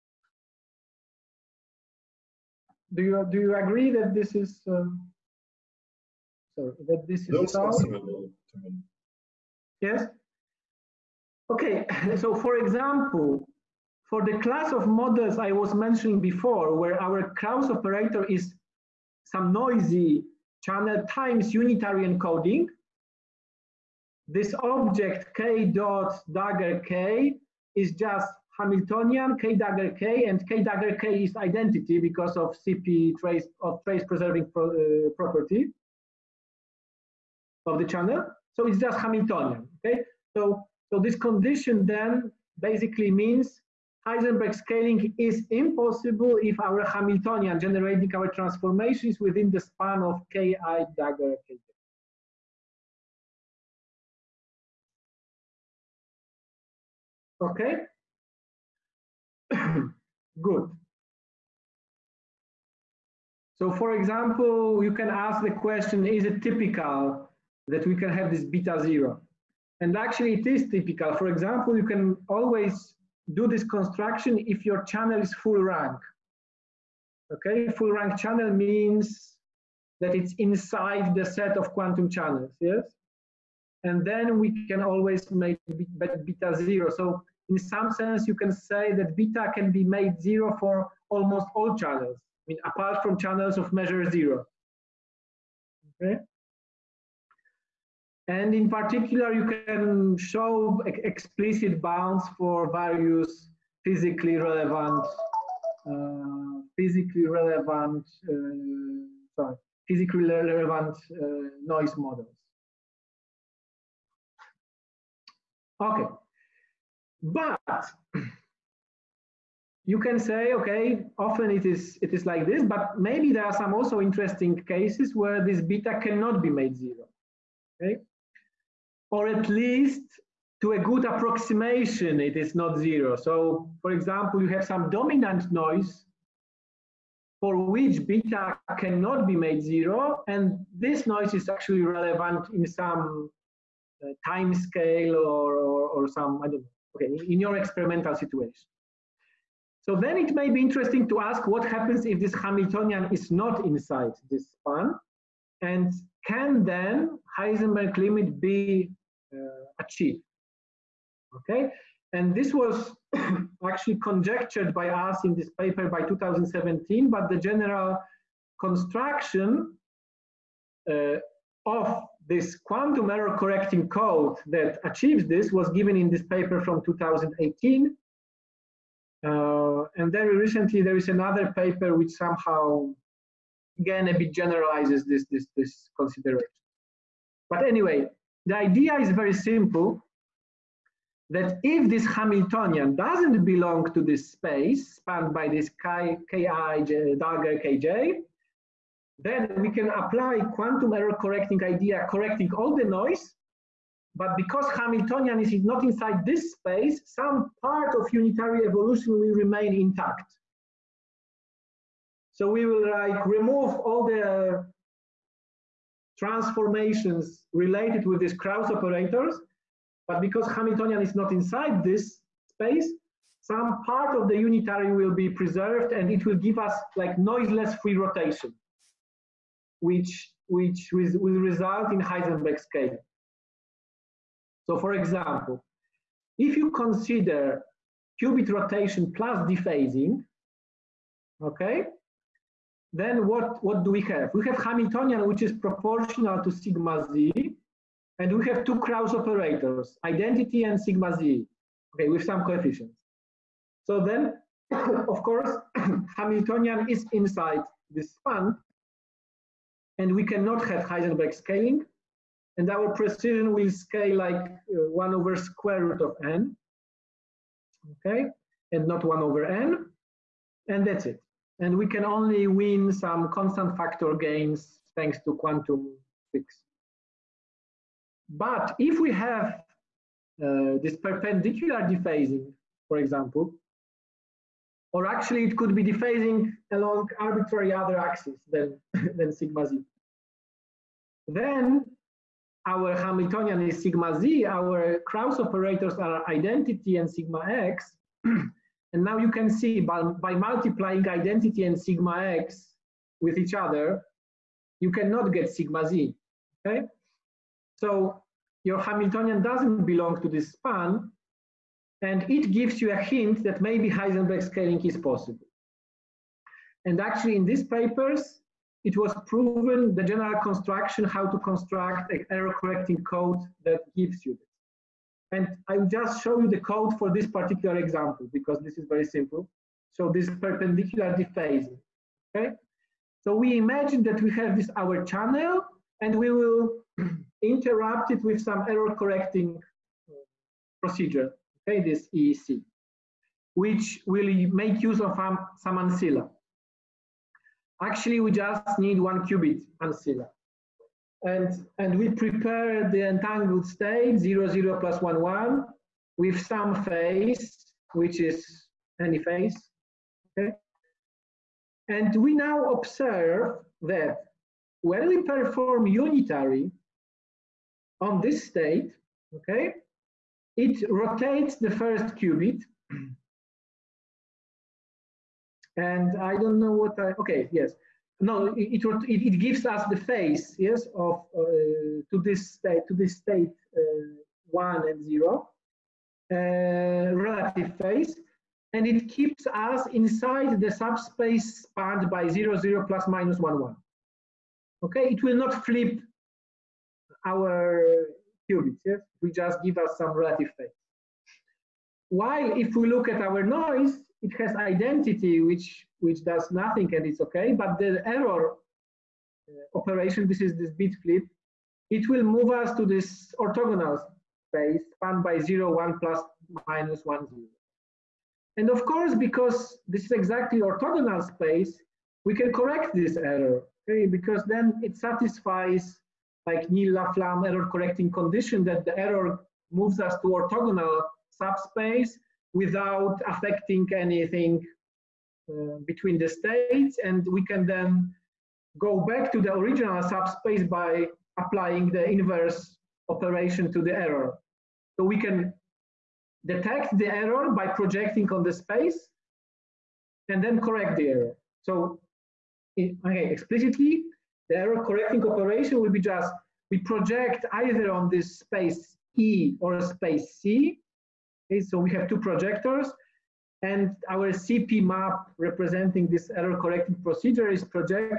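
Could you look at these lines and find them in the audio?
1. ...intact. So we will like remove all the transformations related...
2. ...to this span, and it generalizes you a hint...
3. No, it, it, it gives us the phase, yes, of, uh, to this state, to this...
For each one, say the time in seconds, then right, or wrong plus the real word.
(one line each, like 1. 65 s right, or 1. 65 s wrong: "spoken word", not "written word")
1. 209 s right
2. 310 s wrong: "gives", not "generalizes"
3. 378 s right.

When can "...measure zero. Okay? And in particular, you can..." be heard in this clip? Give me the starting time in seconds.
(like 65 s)
93 s.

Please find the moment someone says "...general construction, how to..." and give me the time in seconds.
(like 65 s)
320 s.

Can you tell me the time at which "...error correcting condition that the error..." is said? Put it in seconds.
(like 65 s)
427 s.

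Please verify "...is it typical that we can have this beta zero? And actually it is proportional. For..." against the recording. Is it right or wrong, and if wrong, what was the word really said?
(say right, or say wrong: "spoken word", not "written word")
wrong: "typical", not "proportional".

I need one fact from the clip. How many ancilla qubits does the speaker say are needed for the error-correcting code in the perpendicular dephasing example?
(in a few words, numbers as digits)
1.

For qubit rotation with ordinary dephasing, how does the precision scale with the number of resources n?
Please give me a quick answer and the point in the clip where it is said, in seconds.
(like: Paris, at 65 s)
1 over square root of n, at 265 s.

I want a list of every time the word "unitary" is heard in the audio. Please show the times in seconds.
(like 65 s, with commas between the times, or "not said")
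21 s, 208 s, 224 s, 365 s.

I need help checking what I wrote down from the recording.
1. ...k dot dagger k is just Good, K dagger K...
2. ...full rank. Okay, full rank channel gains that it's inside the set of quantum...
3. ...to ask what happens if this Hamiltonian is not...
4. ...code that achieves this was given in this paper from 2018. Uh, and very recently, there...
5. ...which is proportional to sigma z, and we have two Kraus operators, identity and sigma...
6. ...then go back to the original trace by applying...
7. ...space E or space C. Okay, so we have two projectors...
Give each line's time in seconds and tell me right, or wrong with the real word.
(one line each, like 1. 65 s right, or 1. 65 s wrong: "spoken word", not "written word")
1. 25 s wrong: "Hamiltonian", not "Good"
2. 75 s wrong: "means", not "gains"
3. 151 s right
4. 173 s right
5. 245 s right
6. 437 s wrong: "subspace", not "trace"
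7. 458 s right.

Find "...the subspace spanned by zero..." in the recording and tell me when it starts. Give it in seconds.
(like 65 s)
390 s.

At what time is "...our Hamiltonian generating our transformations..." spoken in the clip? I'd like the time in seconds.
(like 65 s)
46 s.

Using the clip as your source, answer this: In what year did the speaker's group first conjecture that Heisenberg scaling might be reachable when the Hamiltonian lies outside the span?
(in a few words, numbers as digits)
2017.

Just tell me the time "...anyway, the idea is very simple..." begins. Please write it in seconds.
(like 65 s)
187 s.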